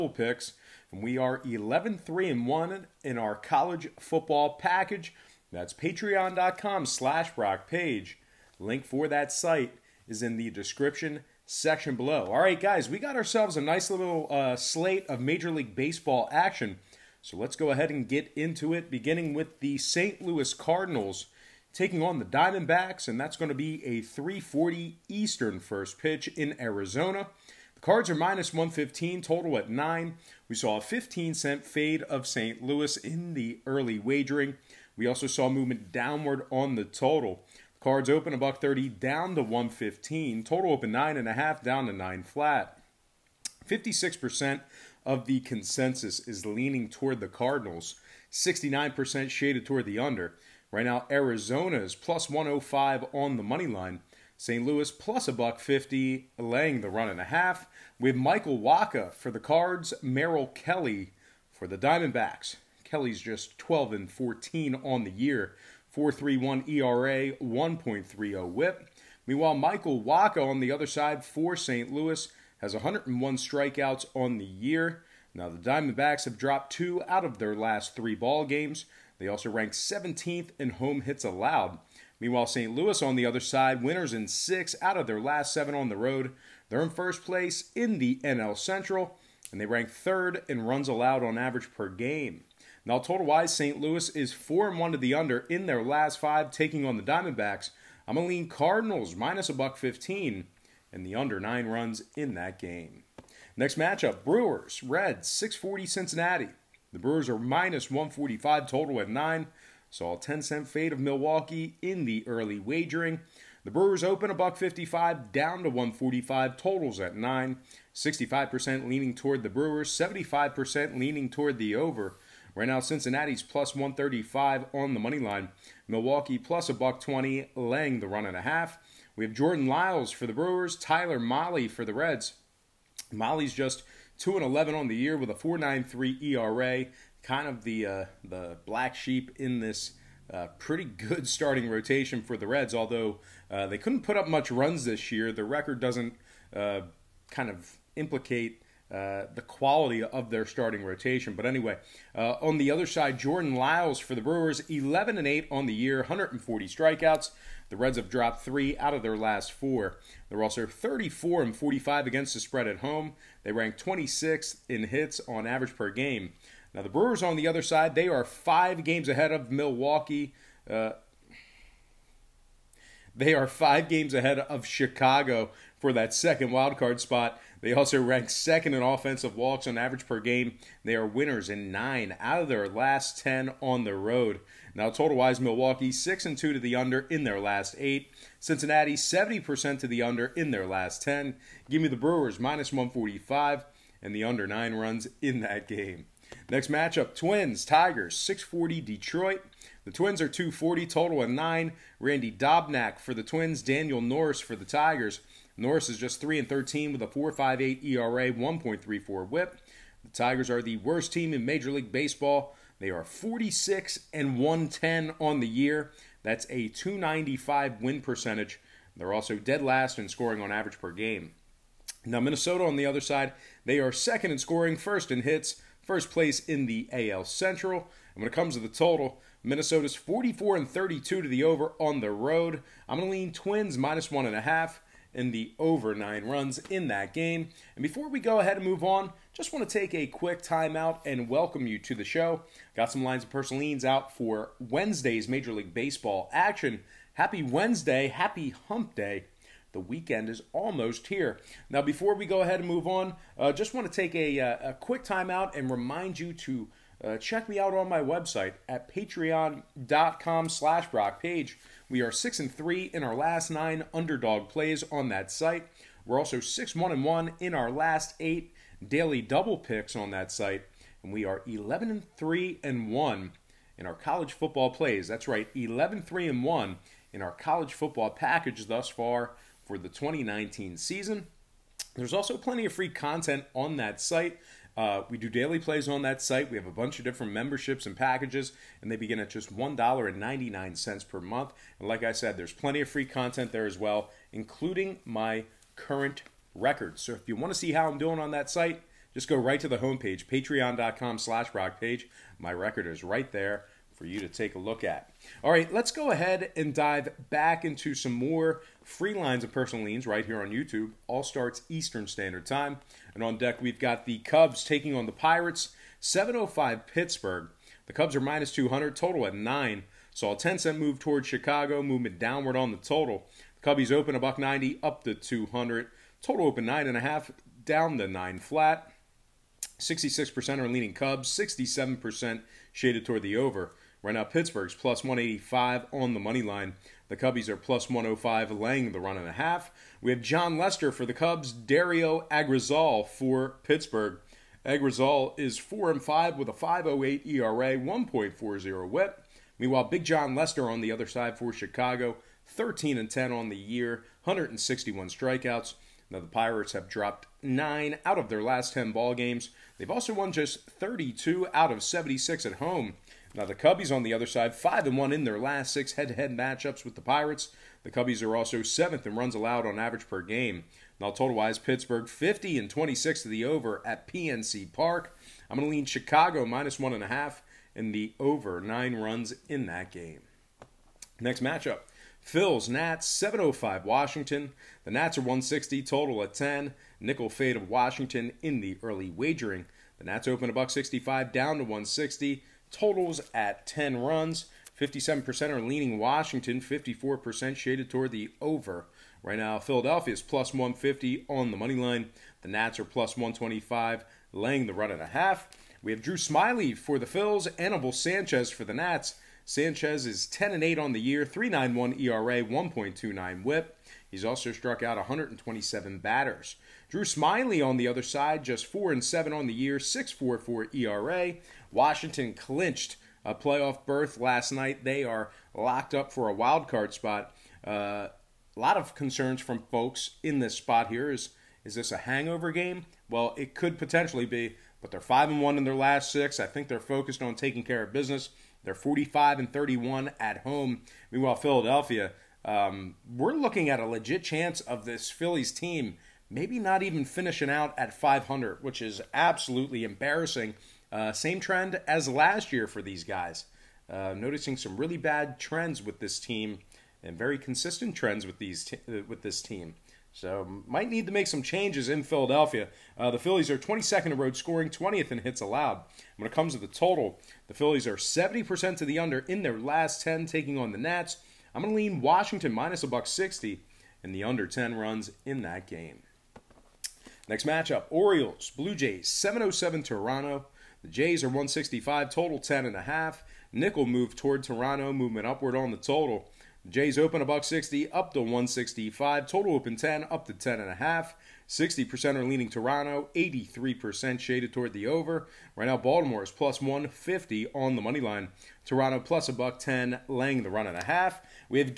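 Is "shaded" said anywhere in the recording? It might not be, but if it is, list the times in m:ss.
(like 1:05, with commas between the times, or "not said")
0:49, 5:32, 6:37, 8:14.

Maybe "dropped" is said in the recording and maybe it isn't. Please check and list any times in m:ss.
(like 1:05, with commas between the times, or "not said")
1:16, 2:38, 5:56.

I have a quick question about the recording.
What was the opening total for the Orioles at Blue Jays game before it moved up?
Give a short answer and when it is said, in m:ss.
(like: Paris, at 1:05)
10, at 8:09.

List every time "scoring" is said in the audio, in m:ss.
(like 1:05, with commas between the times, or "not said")
3:40, 3:44, 7:44.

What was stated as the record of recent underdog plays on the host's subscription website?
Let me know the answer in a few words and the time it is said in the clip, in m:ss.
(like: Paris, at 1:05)
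6 and 3 in last 9, at 4:22.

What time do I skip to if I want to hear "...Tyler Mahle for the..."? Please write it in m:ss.
2:10.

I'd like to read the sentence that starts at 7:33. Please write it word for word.
Uh, noticing some really bad trends with this team and very consistent trends with these uh, with this team.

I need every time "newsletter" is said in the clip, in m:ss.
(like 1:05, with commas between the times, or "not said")
not said.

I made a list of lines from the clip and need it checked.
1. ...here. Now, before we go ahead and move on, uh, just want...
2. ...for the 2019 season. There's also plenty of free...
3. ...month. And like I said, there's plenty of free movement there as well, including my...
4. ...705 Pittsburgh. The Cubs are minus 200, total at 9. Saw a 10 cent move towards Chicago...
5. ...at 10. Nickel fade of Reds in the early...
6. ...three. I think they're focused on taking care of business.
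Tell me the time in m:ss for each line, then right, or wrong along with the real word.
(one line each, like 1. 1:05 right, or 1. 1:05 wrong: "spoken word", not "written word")
1. 4:11 right
2. 4:39 right
3. 4:51 wrong: "content", not "movement"
4. 5:16 right
5. 6:26 wrong: "Washington", not "Reds"
6. 7:16 wrong: "six", not "three".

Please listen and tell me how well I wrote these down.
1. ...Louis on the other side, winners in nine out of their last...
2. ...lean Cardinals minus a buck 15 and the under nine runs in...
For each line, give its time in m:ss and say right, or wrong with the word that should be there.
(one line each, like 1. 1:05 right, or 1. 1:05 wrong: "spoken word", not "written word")
1. 1:22 wrong: "six", not "nine"
2. 1:38 right.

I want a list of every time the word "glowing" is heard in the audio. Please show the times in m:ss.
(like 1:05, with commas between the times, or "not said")
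not said.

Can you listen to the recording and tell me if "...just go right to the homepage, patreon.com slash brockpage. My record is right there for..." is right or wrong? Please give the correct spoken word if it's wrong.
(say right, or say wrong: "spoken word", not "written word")
right.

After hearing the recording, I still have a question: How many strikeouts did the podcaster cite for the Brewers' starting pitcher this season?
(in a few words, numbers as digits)
140.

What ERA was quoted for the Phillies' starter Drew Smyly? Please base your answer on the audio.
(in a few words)
6.44.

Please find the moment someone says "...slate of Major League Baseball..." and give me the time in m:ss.
0:14.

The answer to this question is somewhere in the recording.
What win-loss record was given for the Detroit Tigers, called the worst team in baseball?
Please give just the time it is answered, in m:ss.
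3:33.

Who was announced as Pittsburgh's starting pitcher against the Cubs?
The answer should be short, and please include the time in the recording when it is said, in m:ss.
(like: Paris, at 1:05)
Dario Agrazal, at 5:41.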